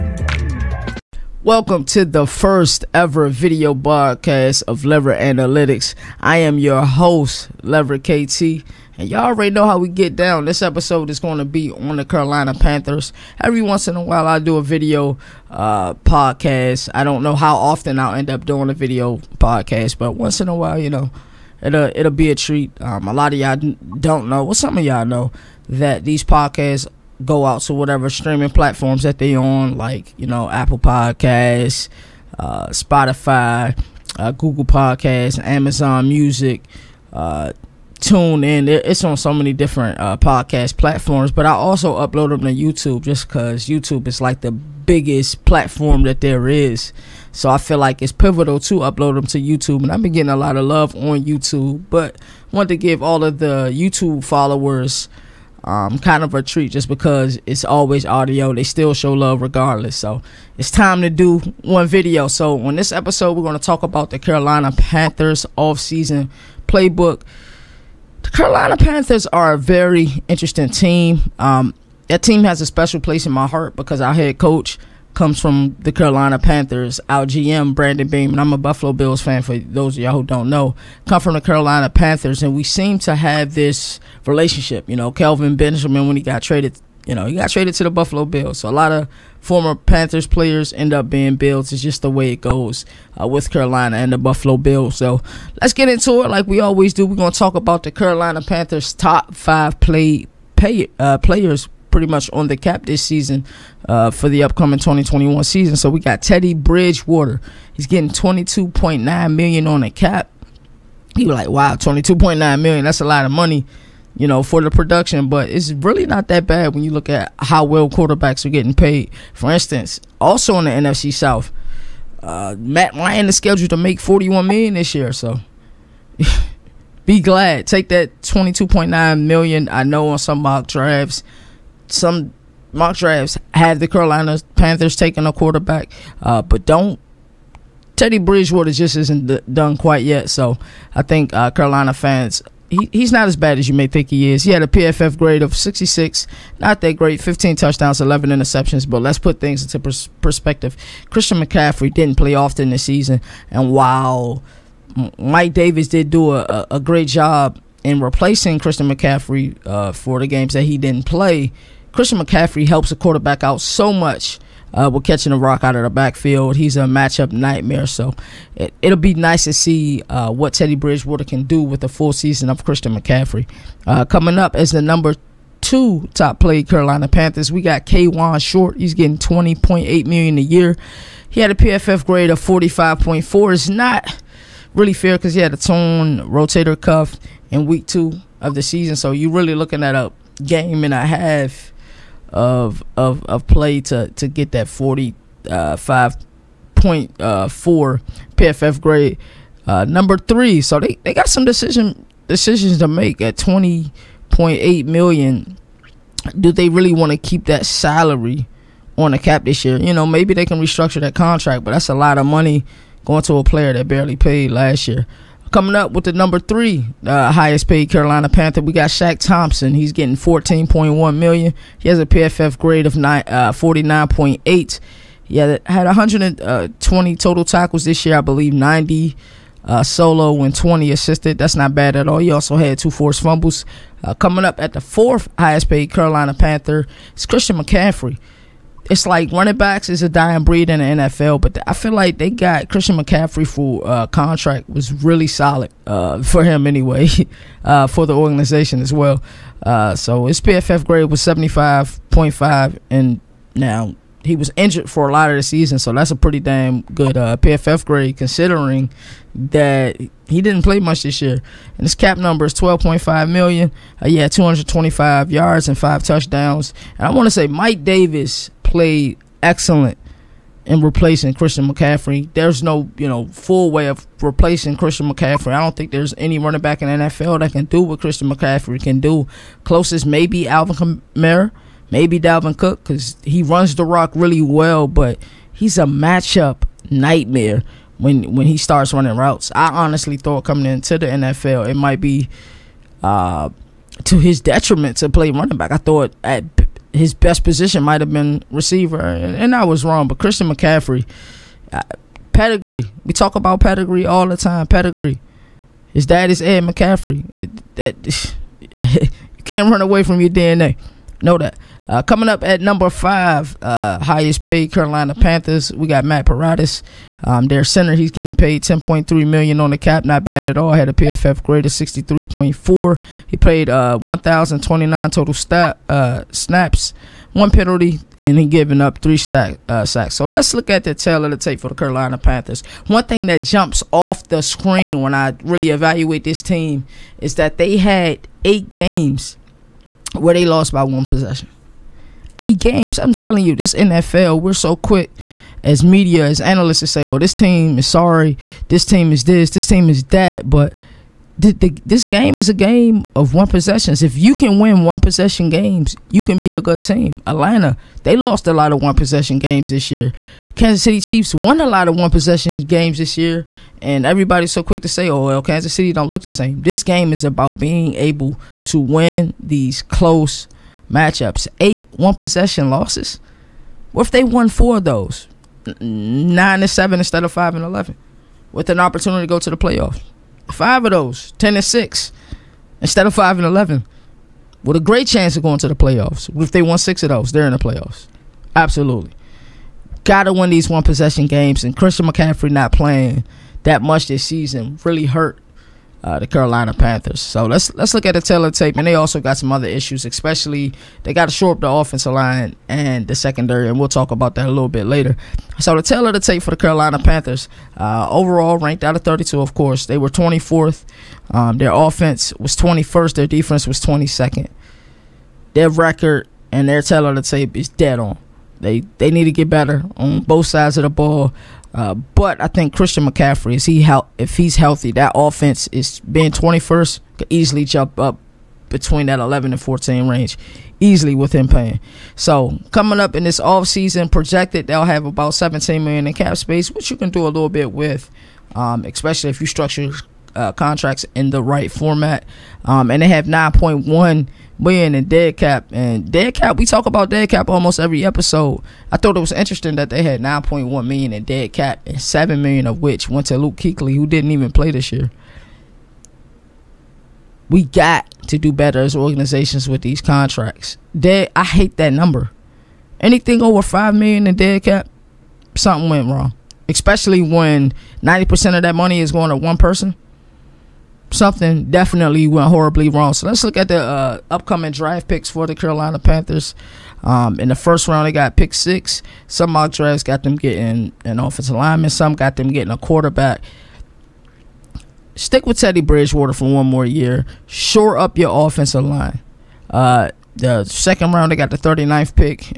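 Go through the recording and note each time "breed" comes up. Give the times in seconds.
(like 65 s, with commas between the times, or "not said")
240 s.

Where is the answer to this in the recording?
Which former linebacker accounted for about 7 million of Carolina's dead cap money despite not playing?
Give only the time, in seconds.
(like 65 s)
453 s.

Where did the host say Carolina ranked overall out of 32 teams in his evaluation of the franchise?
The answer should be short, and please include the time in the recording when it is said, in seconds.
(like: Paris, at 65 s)
24th, at 410 s.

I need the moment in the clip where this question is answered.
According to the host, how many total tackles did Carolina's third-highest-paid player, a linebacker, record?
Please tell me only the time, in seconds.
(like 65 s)
225 s.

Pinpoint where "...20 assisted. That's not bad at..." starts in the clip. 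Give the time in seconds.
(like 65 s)
230 s.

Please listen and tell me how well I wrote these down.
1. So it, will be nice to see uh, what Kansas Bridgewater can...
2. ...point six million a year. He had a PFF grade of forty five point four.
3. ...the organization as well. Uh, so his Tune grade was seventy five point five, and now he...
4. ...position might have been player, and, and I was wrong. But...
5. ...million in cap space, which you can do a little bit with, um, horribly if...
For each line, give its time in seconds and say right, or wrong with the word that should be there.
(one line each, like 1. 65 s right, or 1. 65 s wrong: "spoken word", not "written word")
1. 167 s wrong: "Teddy", not "Kansas"
2. 179 s wrong: "eight", not "six"
3. 248 s wrong: "PFF", not "Tune"
4. 297 s wrong: "receiver", not "player"
5. 435 s wrong: "especially", not "horribly".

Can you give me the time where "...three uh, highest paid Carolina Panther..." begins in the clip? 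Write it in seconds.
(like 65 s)
216 s.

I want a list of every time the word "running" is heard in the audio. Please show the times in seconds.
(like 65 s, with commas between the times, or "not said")
239 s, 276 s, 288 s, 295 s.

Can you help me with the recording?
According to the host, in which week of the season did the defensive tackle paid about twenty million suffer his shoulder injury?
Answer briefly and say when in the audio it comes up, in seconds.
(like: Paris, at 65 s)
week two, at 187 s.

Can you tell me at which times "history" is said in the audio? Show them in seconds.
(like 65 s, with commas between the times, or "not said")
not said.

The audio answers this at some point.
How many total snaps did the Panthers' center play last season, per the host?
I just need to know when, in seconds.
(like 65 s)
323 s.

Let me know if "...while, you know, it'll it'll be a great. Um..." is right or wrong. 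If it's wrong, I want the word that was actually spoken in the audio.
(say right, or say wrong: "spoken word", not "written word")
wrong: "treat", not "great".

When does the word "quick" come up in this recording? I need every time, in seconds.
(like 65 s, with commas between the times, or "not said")
344 s, 364 s.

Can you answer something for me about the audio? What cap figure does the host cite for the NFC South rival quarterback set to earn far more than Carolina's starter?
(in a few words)
41 million.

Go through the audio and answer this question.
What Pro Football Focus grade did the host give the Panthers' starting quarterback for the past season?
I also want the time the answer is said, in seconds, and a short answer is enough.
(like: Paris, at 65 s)
66, at 145 s.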